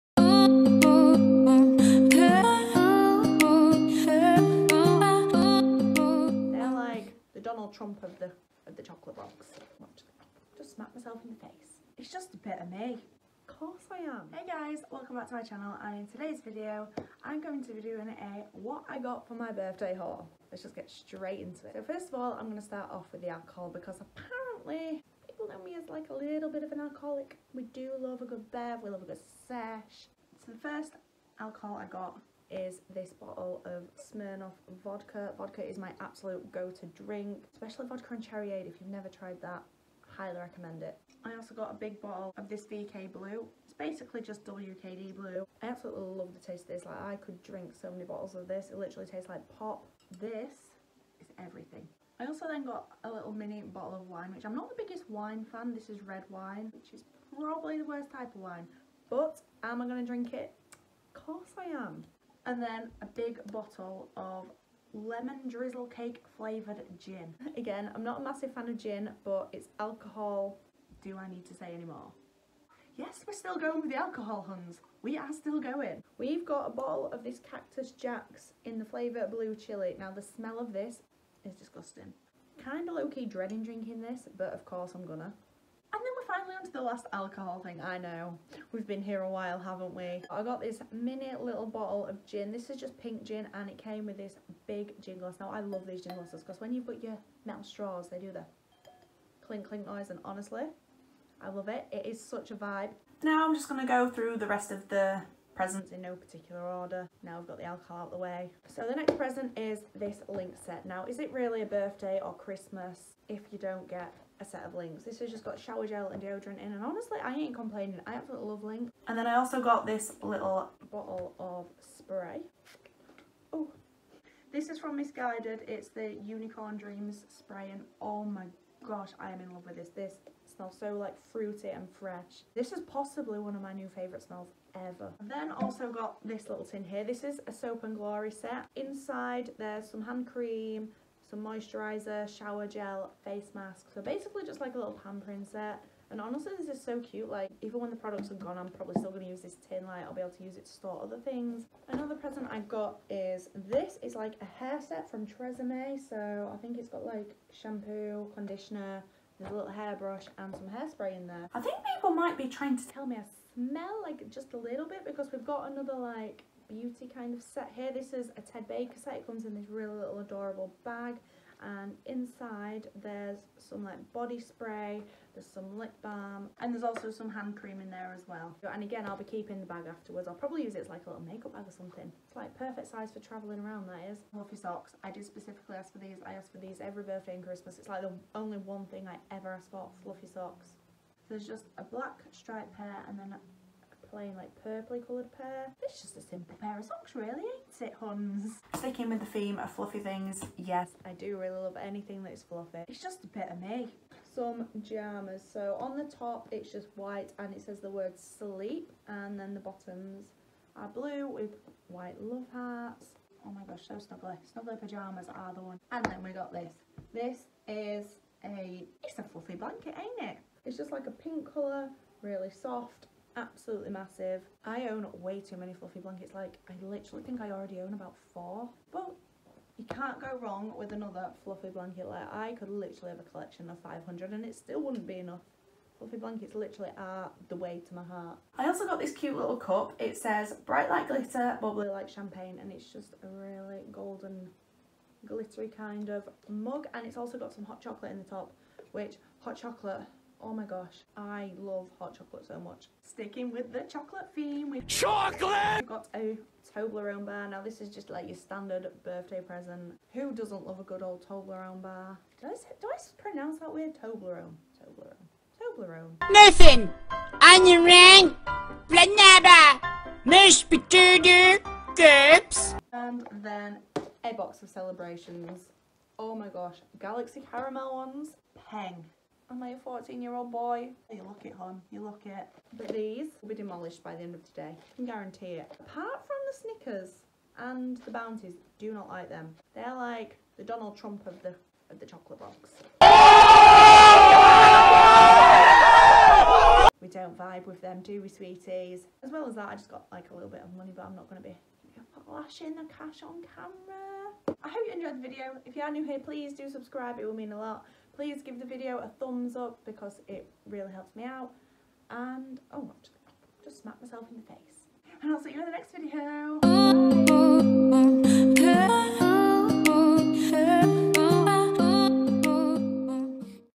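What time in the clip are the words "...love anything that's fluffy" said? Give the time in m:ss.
3:21.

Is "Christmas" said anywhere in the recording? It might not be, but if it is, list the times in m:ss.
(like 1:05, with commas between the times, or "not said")
1:52, 3:07.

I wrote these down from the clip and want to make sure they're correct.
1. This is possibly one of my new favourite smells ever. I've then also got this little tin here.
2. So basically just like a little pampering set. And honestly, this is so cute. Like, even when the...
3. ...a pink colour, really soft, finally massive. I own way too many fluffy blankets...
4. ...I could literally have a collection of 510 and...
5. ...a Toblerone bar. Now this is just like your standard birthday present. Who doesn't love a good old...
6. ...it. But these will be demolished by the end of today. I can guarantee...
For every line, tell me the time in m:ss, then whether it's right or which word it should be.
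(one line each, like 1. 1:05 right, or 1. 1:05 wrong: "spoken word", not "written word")
1. 2:12 right
2. 2:23 right
3. 3:41 wrong: "absolutely", not "finally"
4. 3:52 wrong: "500", not "510"
5. 4:16 right
6. 4:42 right.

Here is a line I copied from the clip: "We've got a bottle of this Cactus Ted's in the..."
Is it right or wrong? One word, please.
wrong.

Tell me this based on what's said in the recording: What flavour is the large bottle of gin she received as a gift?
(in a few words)
Lemon drizzle cake.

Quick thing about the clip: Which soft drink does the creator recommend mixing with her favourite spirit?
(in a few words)
Cherry aid.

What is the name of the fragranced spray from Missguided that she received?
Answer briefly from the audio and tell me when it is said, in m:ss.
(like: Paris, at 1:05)
Unicorn Dreams, at 2:06.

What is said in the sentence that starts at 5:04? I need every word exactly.
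I hope you enjoyed the video.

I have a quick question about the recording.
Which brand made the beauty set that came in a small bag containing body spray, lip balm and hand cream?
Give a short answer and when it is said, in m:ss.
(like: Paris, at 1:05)
Ted Baker, at 2:48.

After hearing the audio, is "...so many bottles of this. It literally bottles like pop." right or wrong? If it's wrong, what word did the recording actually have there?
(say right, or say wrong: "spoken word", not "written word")
wrong: "tastes", not "bottles".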